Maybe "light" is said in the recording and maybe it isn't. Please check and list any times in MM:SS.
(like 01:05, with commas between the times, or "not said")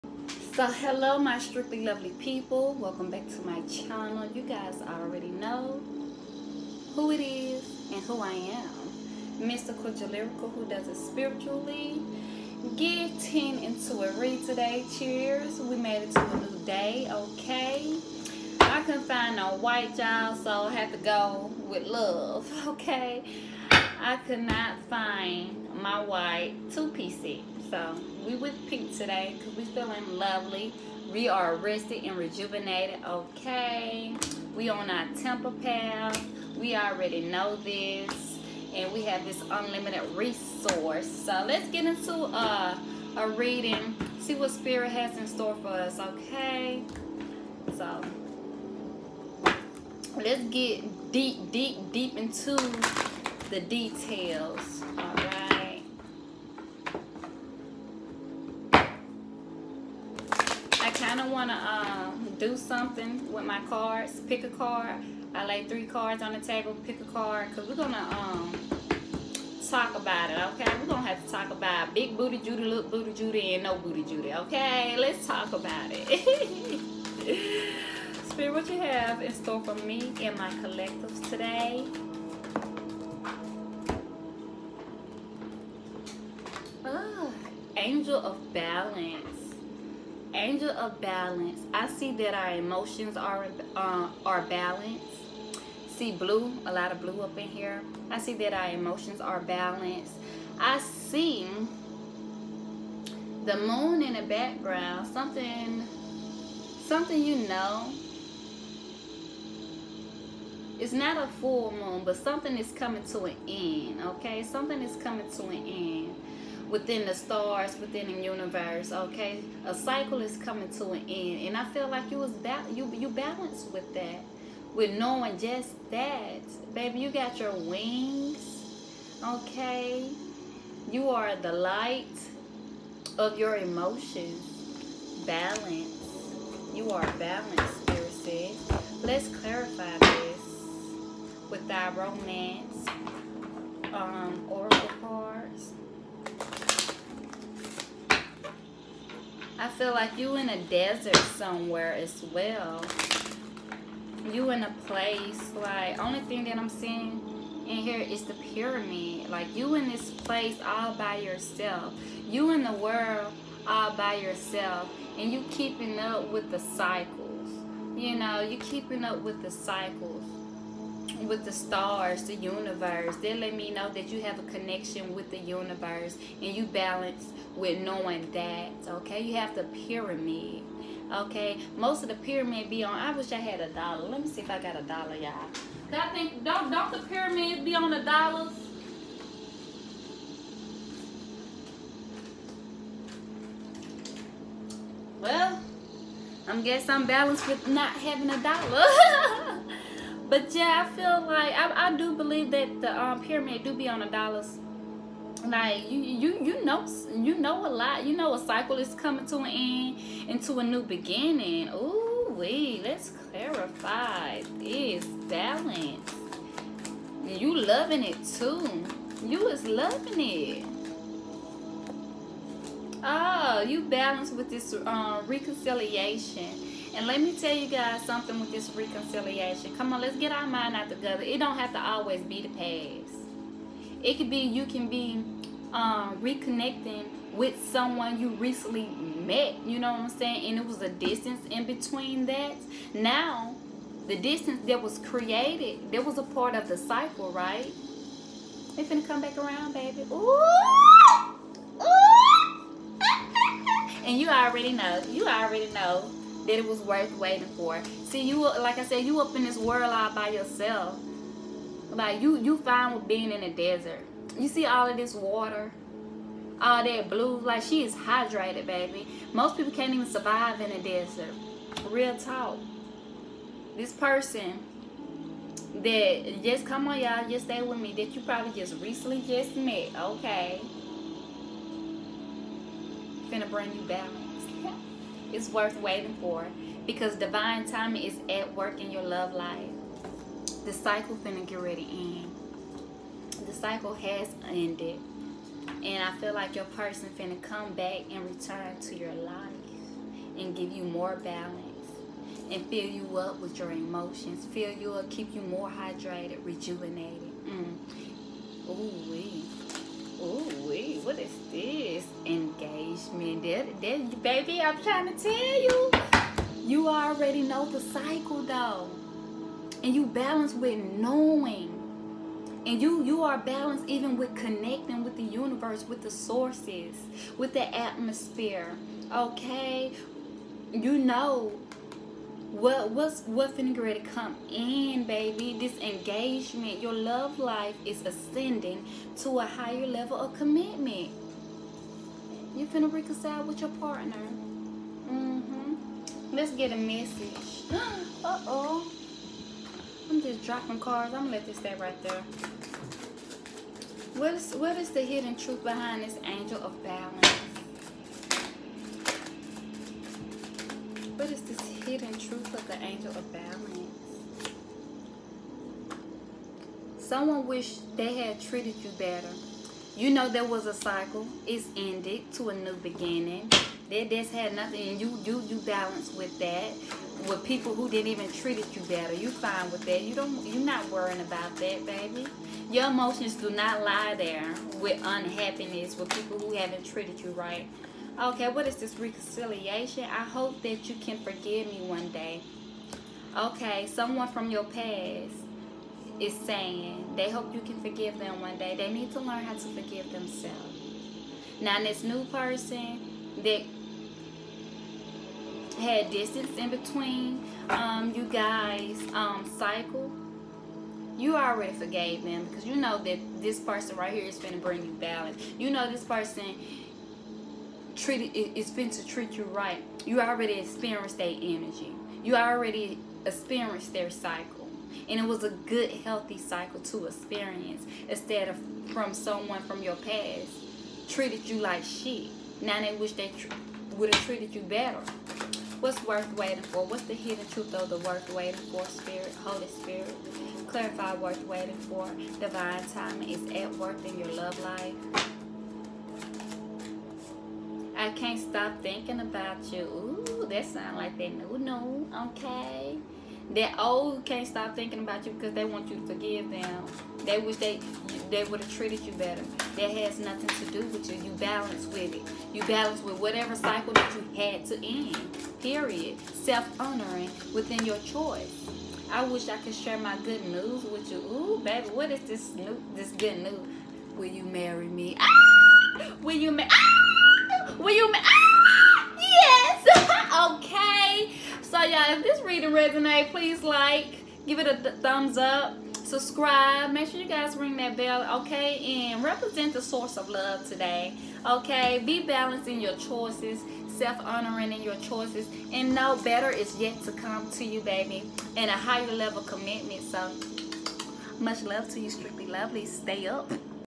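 02:11.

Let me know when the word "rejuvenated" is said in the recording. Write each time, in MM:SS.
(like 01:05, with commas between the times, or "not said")
00:32, 05:06.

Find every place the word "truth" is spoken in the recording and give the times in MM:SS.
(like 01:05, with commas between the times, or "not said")
05:55, 06:02, 07:17.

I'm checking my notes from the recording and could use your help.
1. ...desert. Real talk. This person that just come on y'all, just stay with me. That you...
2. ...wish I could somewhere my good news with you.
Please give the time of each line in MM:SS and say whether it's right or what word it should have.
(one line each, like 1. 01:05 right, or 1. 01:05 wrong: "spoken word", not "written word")
1. 04:30 right
2. 07:49 wrong: "share", not "somewhere".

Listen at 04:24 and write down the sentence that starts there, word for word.
You see all of this water, all that blue.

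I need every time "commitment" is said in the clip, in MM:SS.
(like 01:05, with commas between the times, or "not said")
05:40, 08:19.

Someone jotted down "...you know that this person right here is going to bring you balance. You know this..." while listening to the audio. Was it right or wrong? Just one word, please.
right.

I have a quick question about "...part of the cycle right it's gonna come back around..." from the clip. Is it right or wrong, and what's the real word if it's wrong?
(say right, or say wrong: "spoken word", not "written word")
right.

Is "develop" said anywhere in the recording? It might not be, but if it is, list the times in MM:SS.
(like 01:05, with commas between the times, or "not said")
not said.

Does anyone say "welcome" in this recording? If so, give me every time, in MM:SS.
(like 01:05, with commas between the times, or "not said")
00:02.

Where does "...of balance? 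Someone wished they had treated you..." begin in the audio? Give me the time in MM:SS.
06:03.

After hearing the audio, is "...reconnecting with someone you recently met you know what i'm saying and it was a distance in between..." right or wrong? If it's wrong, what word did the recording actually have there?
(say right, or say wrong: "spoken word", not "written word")
right.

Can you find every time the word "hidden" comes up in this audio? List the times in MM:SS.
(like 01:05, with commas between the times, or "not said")
05:55, 06:01, 07:17.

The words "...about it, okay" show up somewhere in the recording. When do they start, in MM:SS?
01:09.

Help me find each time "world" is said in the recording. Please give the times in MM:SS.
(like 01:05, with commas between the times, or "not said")
02:42, 04:19.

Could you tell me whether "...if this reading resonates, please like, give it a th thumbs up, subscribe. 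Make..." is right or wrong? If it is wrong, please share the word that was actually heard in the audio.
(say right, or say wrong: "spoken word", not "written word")
right.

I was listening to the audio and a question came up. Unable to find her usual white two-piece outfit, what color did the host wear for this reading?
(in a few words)
Pink.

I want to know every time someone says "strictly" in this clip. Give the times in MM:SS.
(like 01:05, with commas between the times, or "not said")
00:01, 08:22.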